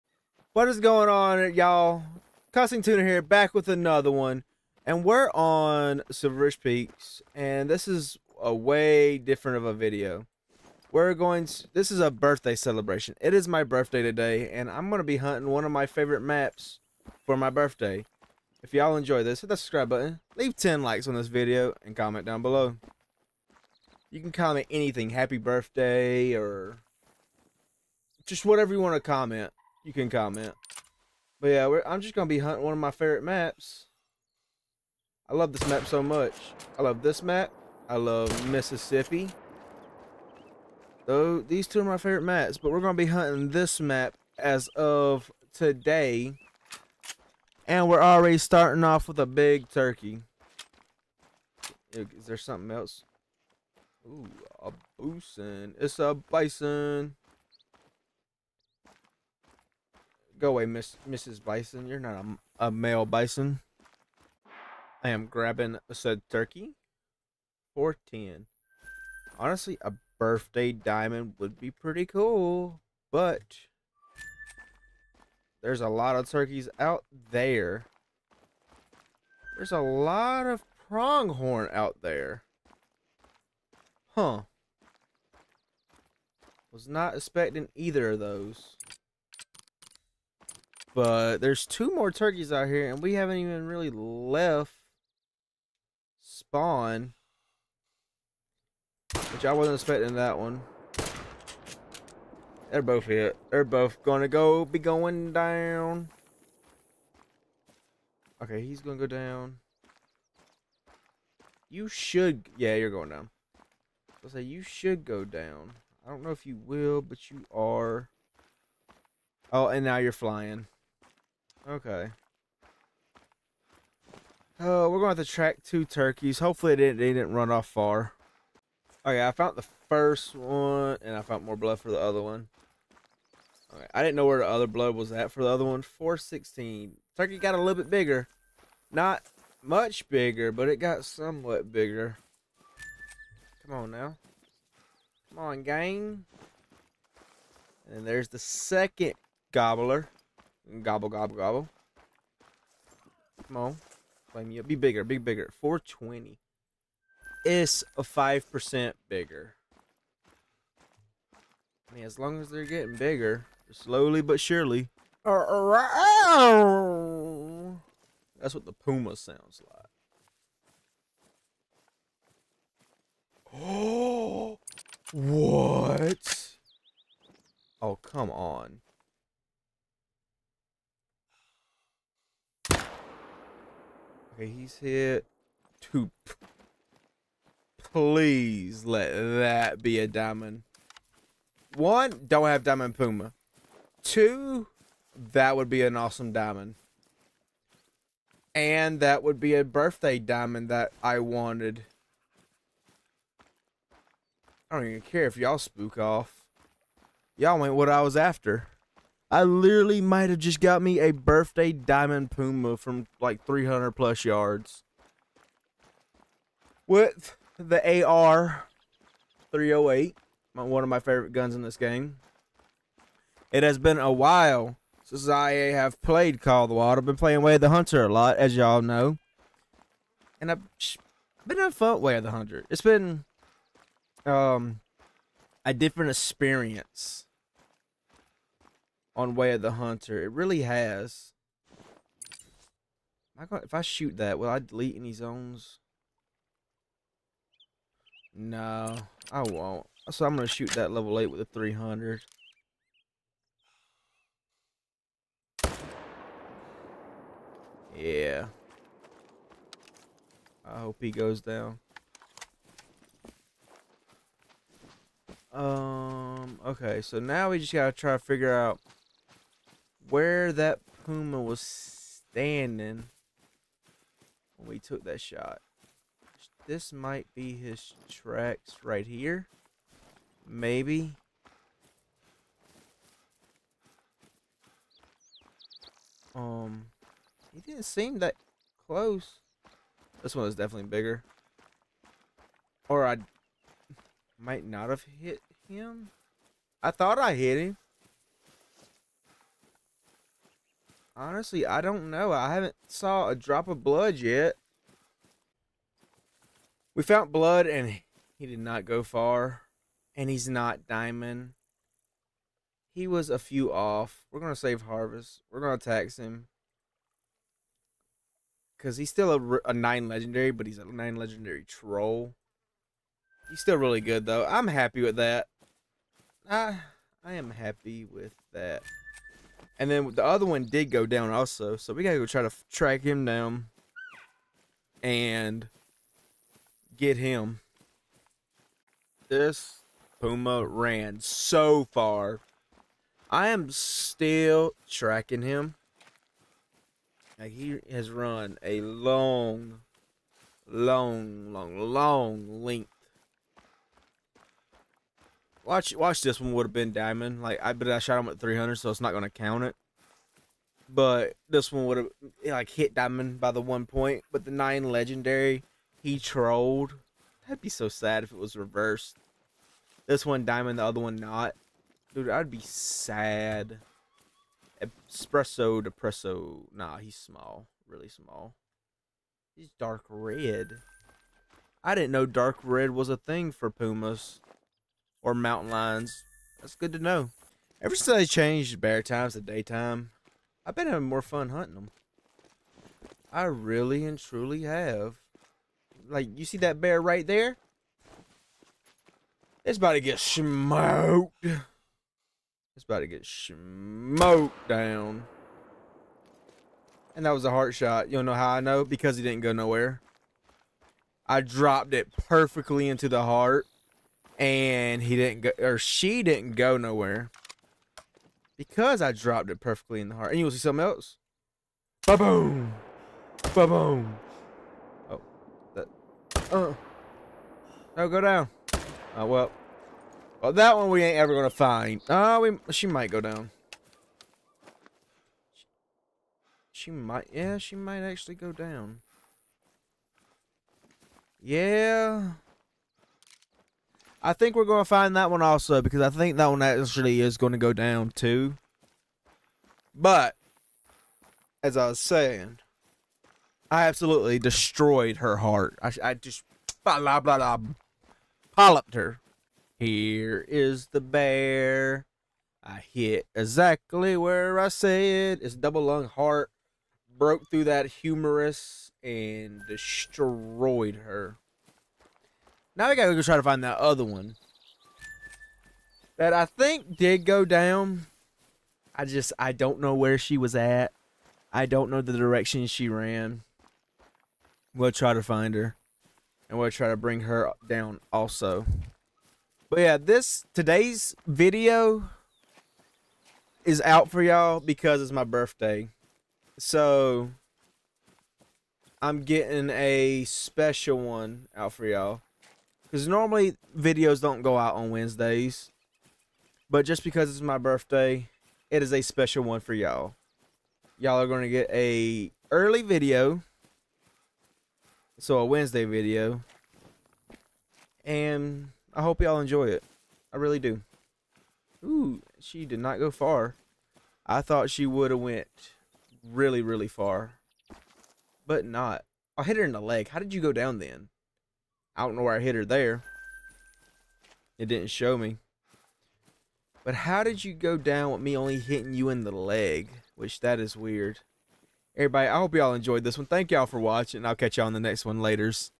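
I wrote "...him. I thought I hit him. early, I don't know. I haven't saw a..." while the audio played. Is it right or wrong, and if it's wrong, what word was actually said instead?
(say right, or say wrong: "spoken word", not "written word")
wrong: "honestly", not "early".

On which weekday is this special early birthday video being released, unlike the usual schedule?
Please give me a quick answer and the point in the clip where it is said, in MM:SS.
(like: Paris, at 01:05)
Wednesday, at 08:24.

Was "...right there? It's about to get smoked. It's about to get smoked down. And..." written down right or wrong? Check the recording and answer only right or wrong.
right.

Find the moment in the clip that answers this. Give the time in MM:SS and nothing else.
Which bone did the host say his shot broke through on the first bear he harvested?
07:47.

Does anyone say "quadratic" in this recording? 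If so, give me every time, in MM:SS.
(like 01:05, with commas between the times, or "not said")
not said.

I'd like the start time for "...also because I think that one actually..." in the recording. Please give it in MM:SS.
07:25.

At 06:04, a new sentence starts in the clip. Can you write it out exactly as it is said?
But the nine legendary, he trolled.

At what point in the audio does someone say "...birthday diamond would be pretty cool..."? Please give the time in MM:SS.
01:10.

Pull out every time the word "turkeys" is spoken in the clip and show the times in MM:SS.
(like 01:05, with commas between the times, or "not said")
00:49, 01:06, 01:16, 01:32, 02:05, 02:17.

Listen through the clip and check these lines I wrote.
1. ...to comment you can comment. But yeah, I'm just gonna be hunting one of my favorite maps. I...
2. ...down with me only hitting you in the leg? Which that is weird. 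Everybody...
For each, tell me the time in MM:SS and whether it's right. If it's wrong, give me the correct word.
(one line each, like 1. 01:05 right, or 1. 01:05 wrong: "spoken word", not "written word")
1. 00:28 right
2. 08:57 right.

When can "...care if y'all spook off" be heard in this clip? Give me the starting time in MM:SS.
03:25.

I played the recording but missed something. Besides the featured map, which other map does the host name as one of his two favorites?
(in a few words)
Mississippi.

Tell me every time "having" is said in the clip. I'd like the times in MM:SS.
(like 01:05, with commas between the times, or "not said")
03:51, 06:30.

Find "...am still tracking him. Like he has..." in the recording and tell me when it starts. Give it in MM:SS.
05:43.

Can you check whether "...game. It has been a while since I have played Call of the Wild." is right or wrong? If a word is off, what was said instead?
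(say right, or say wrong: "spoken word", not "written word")
right.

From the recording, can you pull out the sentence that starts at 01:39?
Which I wasn't expecting that one.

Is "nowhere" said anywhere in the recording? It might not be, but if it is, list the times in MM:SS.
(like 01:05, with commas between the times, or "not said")
06:49, 06:56.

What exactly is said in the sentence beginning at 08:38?
And I hope y'all enjoy it.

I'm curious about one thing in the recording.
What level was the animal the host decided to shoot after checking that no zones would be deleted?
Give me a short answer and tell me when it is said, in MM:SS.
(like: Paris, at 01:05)
8, at 04:10.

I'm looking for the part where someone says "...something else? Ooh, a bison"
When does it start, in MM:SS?
00:52.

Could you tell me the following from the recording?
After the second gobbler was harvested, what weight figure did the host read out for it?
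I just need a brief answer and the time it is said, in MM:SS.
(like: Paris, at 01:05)
420, at 02:35.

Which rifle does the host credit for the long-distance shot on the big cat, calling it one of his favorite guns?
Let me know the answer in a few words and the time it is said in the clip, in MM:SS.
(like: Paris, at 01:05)
AR 308, at 03:38.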